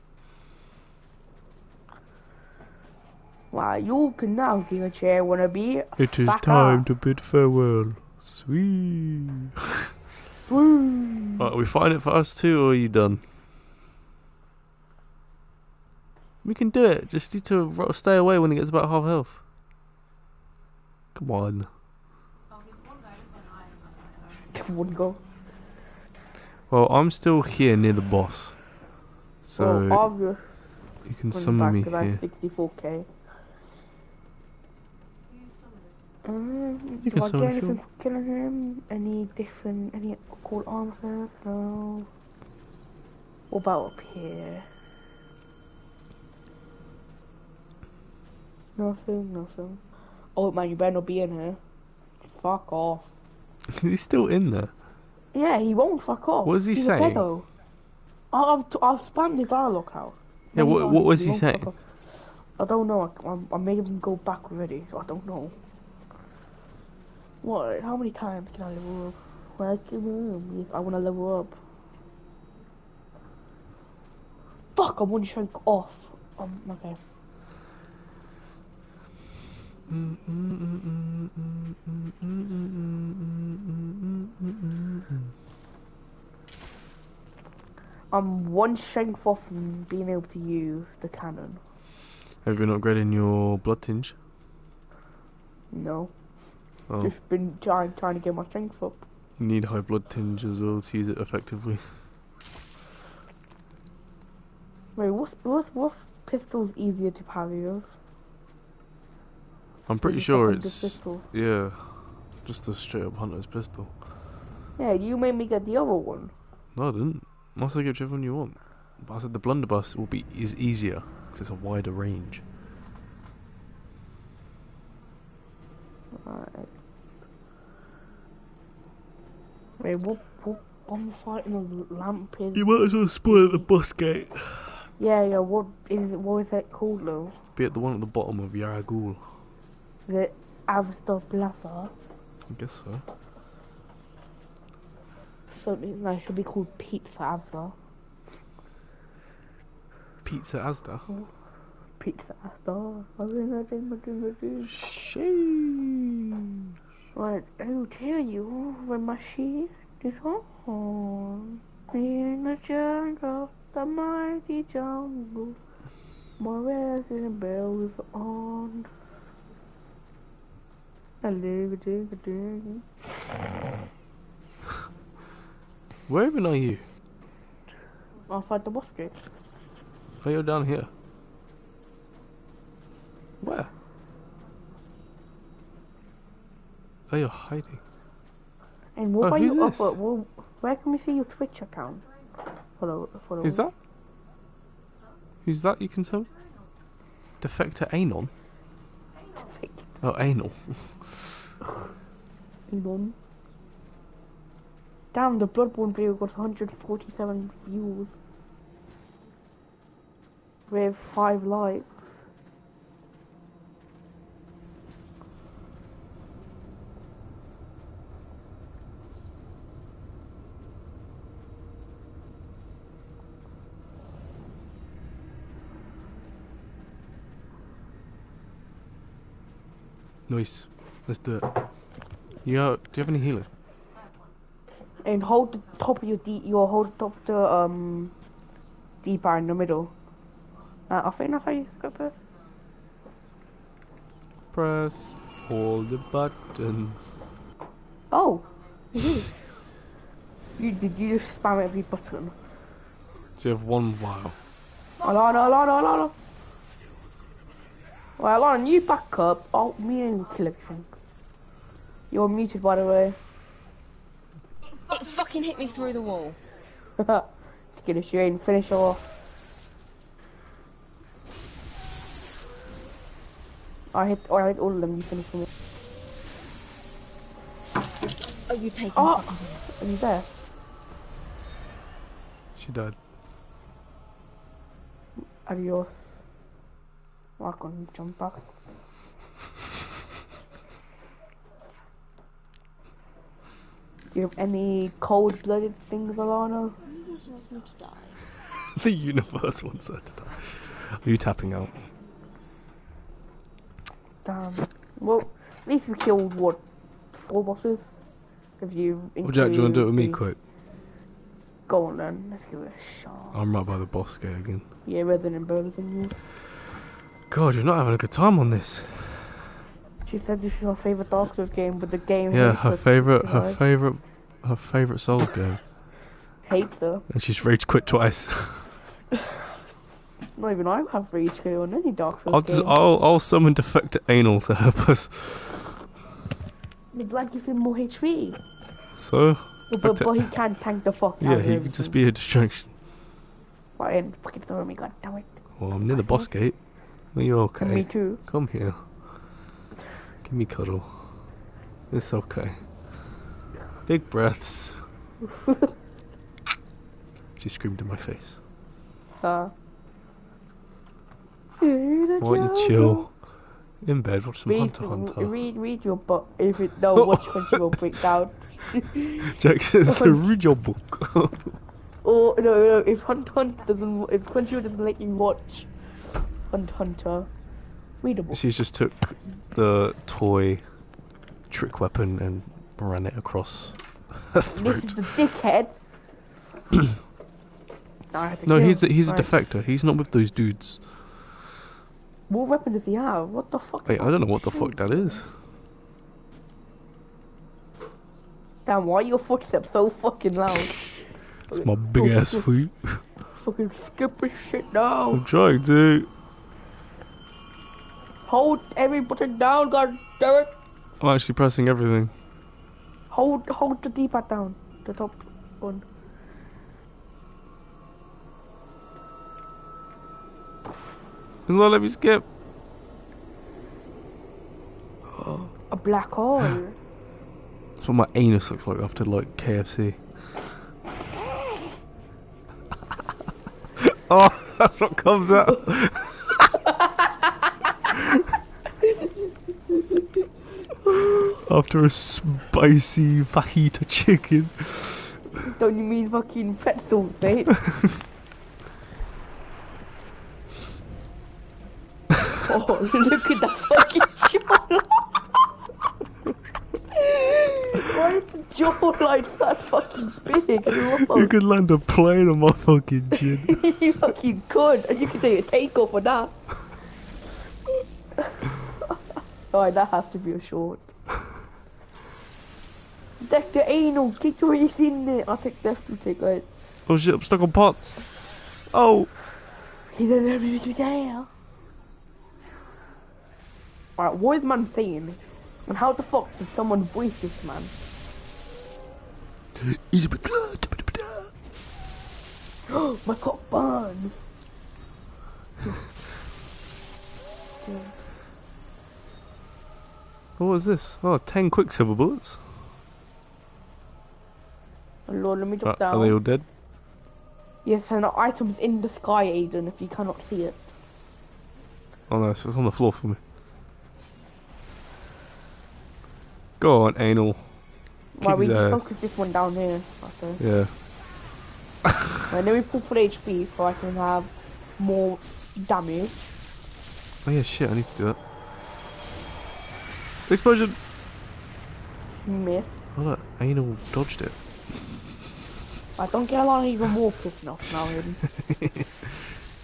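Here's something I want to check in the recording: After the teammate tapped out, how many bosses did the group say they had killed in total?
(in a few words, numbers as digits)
4.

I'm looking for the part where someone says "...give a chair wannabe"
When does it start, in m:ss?
0:04.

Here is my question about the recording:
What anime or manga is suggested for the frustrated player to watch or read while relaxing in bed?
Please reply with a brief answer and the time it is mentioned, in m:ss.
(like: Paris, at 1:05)
Hunter Hunter, at 6:04.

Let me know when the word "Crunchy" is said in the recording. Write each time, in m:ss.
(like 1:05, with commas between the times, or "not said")
6:07, 6:14.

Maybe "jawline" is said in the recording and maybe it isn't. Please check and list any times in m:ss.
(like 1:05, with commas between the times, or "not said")
7:34, 7:38.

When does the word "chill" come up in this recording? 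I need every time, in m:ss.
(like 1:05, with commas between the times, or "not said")
6:02.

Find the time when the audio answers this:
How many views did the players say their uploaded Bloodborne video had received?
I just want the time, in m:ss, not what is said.
3:26.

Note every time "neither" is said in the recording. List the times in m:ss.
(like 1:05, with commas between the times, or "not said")
not said.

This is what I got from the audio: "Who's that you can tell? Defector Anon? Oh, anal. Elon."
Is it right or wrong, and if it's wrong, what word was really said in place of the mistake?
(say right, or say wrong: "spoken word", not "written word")
right.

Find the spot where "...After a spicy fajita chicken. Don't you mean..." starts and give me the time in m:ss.
7:21.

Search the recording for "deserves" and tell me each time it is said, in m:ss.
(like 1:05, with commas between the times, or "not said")
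not said.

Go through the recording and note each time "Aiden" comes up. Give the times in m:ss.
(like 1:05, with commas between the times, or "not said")
8:29, 8:57.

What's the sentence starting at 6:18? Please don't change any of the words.
She just took the toy trick weapon and ran it across her throat.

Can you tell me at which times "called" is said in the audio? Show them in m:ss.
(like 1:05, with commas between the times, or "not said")
2:16, 2:26.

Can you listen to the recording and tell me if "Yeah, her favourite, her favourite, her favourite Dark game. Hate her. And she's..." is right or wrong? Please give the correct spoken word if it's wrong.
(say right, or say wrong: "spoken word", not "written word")
wrong: "Souls", not "Dark".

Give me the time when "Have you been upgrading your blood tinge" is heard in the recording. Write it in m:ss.
1:32.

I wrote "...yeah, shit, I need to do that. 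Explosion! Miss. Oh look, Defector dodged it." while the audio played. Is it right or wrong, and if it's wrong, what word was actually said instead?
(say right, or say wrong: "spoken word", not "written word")
wrong: "Anal", not "Defector".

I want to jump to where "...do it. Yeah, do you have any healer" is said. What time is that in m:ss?
3:51.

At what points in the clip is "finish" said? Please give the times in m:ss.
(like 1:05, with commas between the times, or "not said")
4:28, 4:35.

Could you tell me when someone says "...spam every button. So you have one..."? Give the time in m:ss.
4:11.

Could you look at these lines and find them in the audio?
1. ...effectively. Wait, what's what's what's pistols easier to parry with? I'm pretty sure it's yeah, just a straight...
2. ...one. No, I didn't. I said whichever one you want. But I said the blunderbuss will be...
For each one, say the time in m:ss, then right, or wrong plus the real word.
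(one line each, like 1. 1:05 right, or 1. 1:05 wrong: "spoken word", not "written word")
1. 1:41 right
2. 1:55 right.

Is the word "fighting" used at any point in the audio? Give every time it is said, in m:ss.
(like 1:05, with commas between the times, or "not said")
2:11.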